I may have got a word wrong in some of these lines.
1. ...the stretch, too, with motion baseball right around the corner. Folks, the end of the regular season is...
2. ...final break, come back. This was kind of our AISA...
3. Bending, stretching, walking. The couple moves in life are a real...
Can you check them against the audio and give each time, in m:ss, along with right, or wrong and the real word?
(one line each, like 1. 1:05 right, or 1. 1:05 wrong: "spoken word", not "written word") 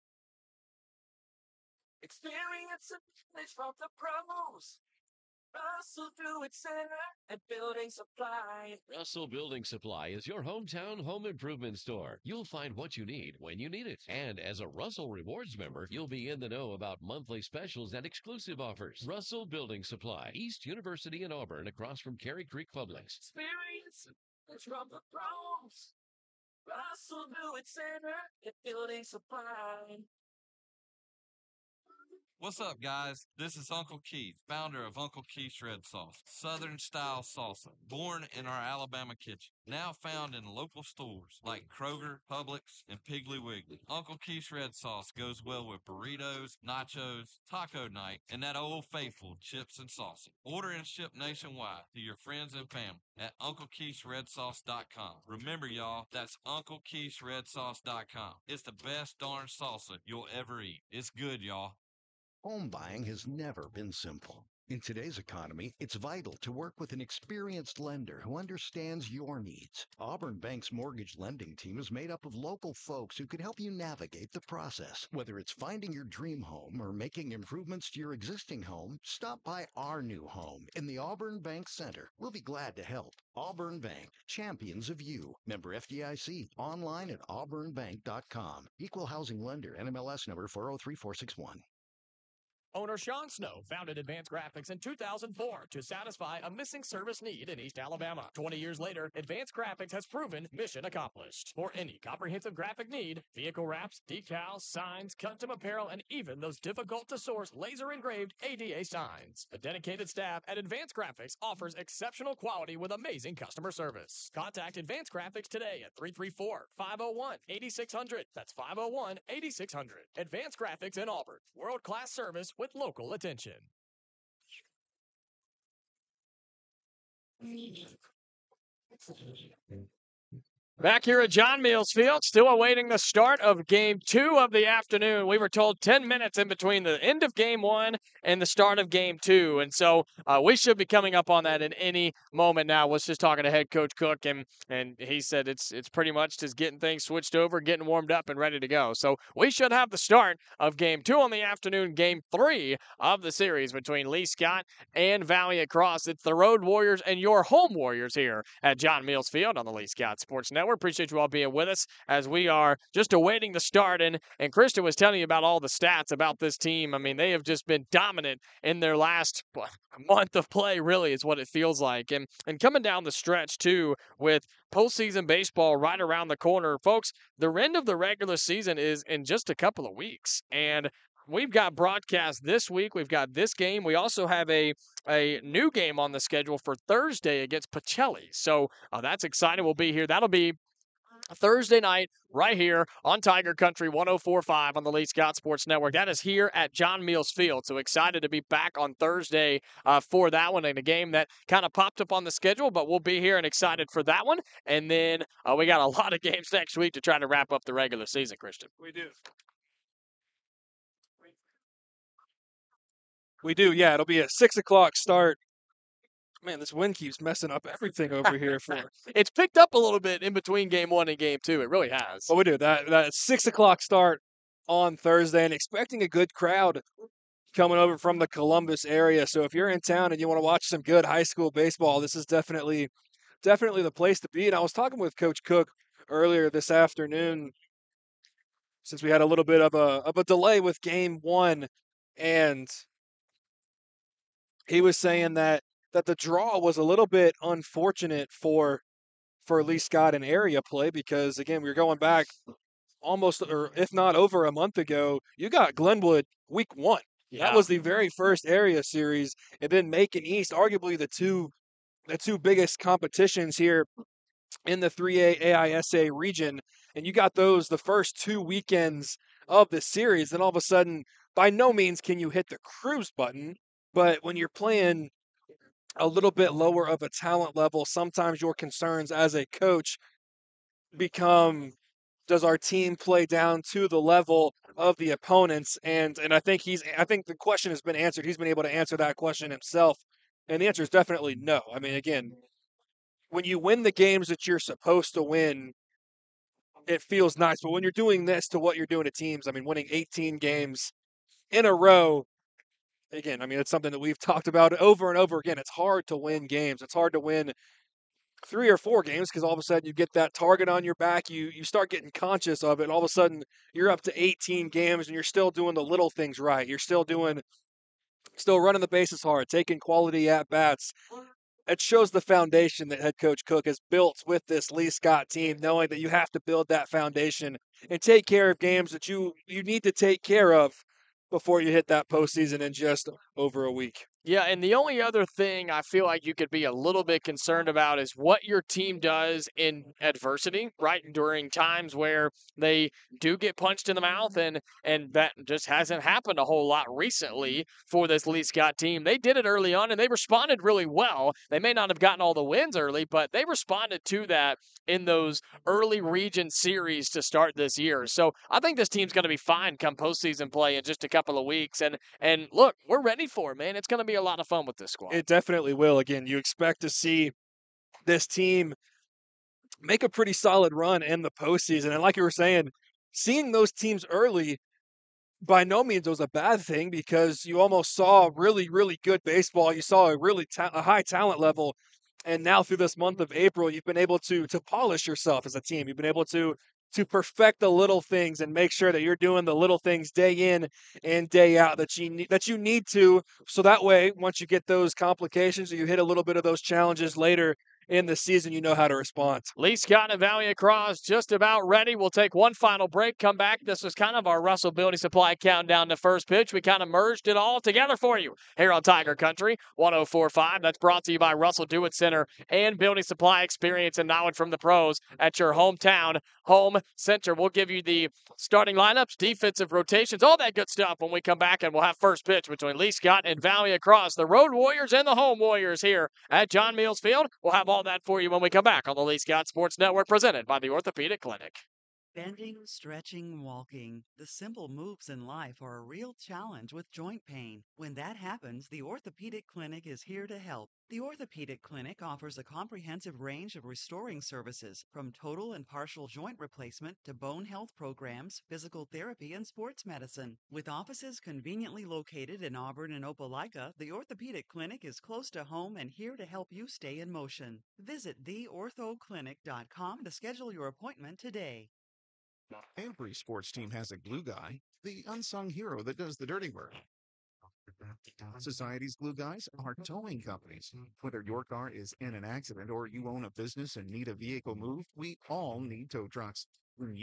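1. 2:53 wrong: "postseason", not "motion"
2. 6:42 wrong: "Russell", not "AISA"
3. 7:12 wrong: "simple", not "couple".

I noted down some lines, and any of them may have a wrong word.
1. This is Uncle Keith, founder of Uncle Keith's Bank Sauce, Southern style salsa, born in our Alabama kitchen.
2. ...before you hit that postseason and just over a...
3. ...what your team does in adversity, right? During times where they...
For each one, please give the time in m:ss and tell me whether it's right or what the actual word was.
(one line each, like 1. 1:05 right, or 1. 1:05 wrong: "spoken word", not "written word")
1. 0:33 wrong: "Red", not "Bank"
2. 5:31 right
3. 5:38 right.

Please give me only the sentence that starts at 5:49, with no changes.
They did it early on and they responded really well.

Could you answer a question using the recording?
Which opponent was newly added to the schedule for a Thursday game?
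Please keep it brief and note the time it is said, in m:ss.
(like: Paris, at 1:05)
Pacelli, at 3:07.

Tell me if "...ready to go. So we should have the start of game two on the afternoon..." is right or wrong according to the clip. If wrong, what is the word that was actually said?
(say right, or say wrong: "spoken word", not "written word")
right.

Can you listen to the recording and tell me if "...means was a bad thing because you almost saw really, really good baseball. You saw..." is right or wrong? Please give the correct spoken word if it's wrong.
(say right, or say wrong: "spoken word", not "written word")
right.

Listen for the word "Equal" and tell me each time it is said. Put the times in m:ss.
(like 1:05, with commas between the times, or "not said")
1:28.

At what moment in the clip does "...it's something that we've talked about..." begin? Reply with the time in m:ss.
5:03.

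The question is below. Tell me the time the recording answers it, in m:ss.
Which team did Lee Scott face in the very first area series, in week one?
4:15.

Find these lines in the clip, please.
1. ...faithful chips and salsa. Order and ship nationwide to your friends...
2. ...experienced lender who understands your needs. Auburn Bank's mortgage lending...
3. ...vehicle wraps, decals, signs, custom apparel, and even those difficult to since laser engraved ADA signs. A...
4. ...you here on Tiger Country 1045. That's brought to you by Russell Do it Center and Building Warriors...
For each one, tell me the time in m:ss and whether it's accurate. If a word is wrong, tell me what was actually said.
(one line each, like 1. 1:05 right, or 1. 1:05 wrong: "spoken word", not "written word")
1. 0:48 right
2. 1:07 right
3. 1:43 wrong: "source", not "since"
4. 6:48 wrong: "Supply", not "Warriors".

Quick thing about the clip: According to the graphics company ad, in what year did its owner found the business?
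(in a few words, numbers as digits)
2004.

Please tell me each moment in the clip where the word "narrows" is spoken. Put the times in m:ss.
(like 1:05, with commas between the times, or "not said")
not said.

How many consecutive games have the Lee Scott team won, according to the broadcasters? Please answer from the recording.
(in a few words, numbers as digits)
18.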